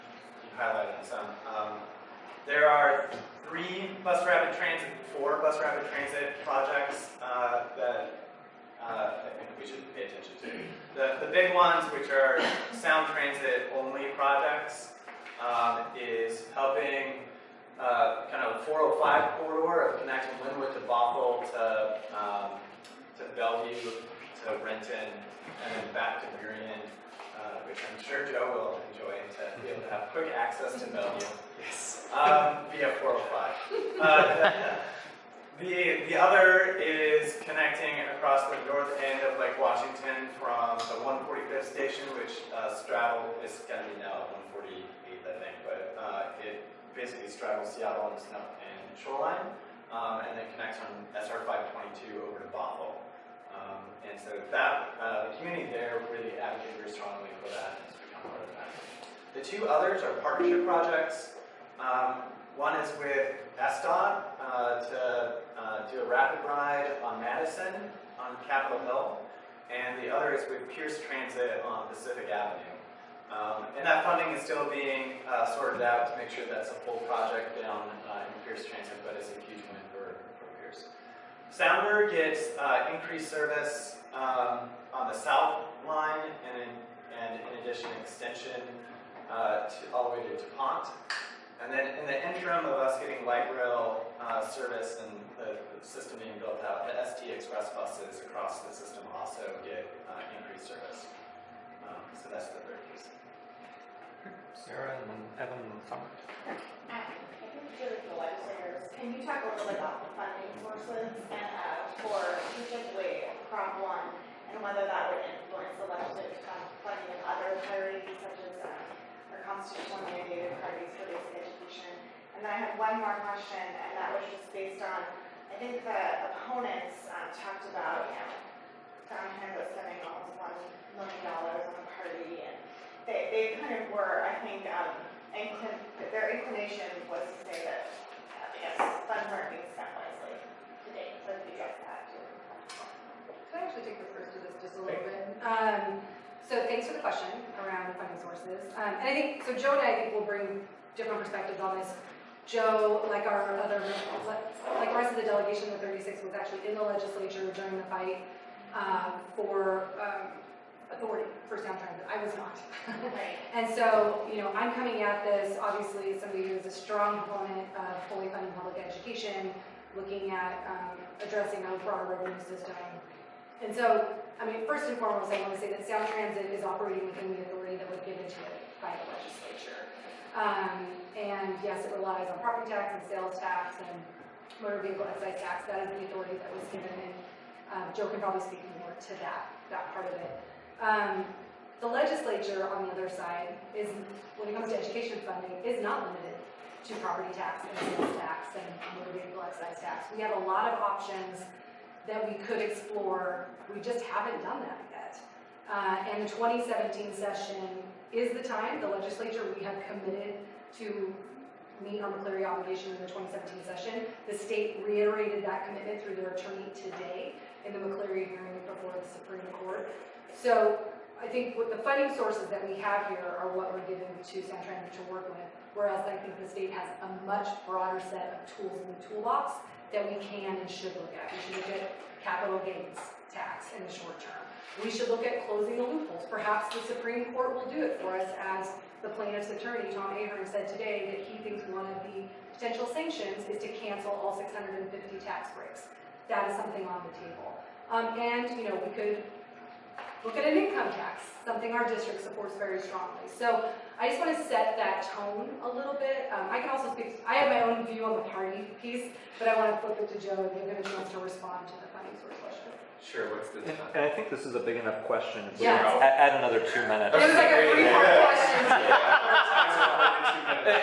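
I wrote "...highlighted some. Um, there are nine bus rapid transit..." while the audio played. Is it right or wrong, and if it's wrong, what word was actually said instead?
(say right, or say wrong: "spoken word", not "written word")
wrong: "three", not "nine".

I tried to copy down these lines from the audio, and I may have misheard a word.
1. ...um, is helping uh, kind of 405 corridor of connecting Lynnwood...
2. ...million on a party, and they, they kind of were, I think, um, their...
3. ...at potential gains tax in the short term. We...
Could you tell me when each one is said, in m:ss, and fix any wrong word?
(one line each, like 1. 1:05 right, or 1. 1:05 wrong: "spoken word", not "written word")
1. 0:15 right
2. 2:10 right
3. 3:51 wrong: "capital", not "potential".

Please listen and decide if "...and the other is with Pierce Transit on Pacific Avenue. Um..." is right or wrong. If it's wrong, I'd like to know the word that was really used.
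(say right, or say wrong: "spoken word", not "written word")
right.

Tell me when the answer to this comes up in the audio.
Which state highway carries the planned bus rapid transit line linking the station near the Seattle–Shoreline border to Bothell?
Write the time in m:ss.
0:51.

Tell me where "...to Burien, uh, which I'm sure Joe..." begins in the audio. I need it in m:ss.
0:26.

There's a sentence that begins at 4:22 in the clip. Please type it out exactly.
Sure, what's the And I think this is a big enough question.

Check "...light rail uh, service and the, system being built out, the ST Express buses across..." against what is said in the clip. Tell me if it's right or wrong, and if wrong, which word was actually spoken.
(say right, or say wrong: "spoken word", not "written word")
right.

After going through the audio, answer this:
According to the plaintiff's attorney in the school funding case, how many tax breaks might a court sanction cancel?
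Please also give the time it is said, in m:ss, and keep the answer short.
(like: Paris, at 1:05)
650, at 4:04.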